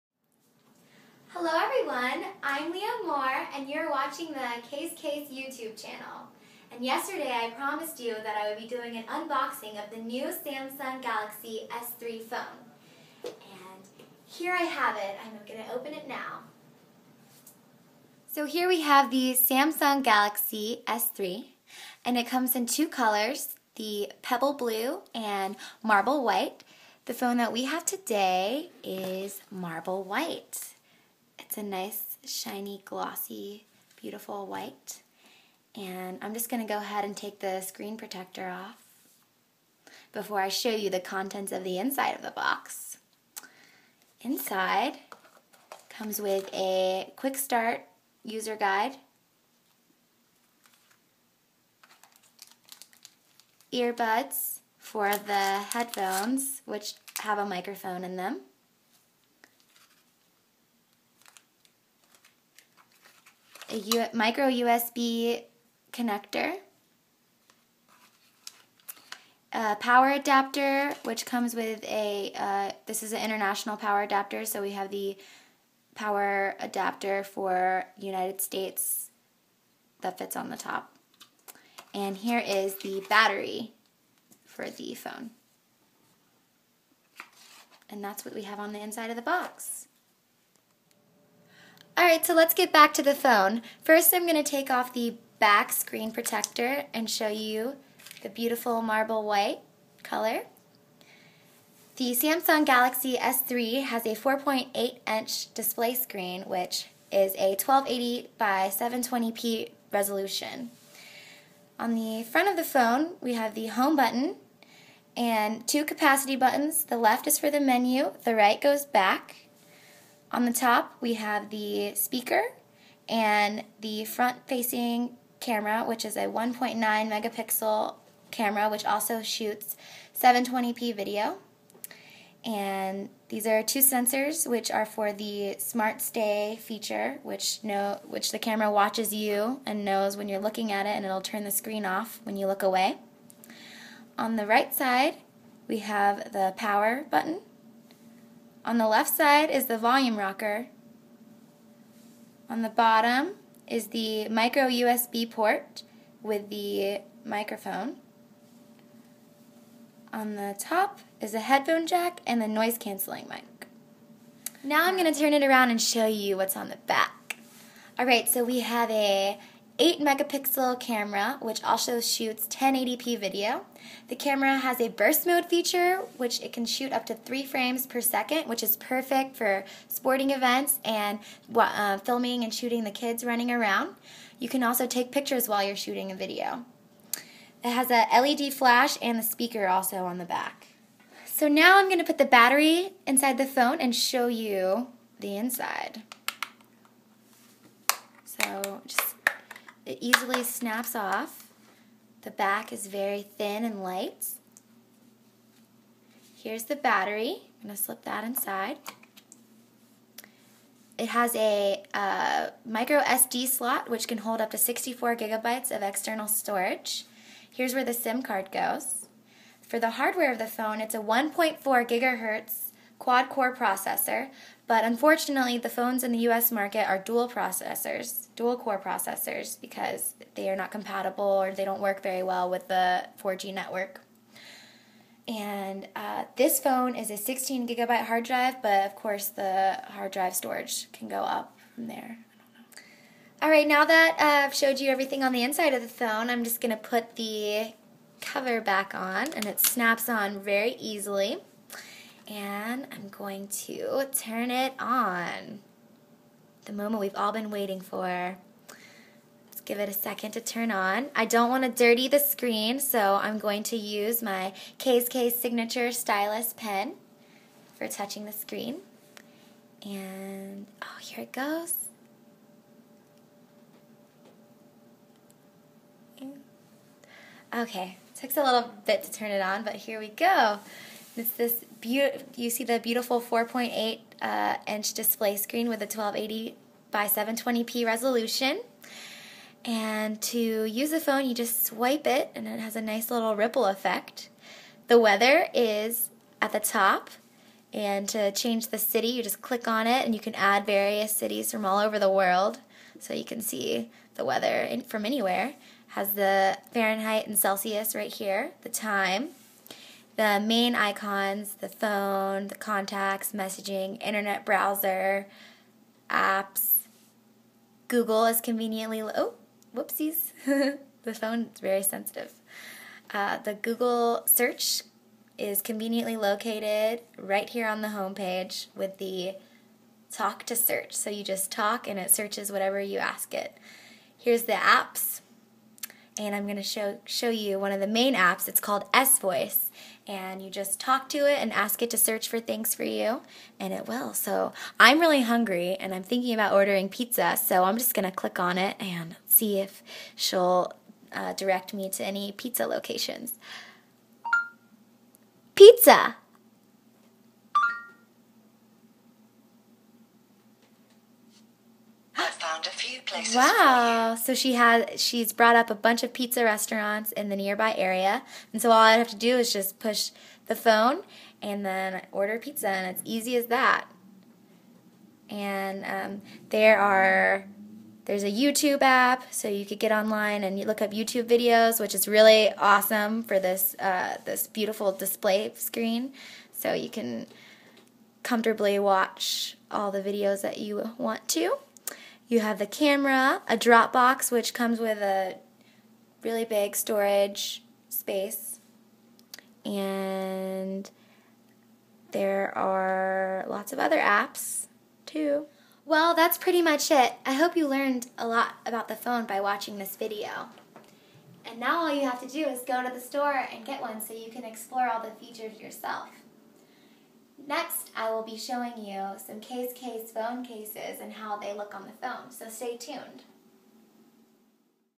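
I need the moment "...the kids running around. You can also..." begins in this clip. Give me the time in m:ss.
3:02.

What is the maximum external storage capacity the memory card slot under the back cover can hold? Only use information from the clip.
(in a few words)
64 gigabytes.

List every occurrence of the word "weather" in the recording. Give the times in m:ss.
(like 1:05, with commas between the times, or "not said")
4:54, 5:04.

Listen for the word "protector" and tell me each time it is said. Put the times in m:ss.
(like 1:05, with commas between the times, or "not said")
0:37, 1:36.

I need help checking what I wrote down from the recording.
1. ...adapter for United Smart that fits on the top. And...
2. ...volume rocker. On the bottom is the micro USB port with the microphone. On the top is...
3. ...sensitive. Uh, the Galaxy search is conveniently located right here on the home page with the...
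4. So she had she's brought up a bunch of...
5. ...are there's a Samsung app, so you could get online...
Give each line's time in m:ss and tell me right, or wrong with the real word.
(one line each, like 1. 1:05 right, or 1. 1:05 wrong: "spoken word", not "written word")
1. 1:16 wrong: "States", not "Smart"
2. 2:29 right
3. 5:21 wrong: "Google", not "Galaxy"
4. 6:04 right
5. 6:16 wrong: "YouTube", not "Samsung".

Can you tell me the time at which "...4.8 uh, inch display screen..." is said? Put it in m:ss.
4:43.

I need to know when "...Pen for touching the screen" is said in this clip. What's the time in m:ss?
4:26.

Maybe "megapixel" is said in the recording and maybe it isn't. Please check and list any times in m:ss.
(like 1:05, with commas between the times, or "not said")
2:06, 2:49.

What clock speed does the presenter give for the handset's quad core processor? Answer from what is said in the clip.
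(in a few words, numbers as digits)
1.4 gigahertz.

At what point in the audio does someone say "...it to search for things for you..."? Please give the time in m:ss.
5:41.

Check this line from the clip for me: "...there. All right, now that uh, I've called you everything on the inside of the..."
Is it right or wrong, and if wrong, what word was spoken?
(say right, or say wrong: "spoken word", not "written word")
wrong: "showed", not "called".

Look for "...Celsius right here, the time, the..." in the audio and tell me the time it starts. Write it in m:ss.
5:07.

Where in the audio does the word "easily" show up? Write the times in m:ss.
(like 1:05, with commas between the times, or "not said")
3:20, 4:10.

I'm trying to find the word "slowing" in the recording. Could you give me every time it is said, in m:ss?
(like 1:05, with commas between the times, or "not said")
not said.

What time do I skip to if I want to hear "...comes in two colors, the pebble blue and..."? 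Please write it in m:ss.
0:22.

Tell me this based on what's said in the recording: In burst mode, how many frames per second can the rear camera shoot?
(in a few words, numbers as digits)
3.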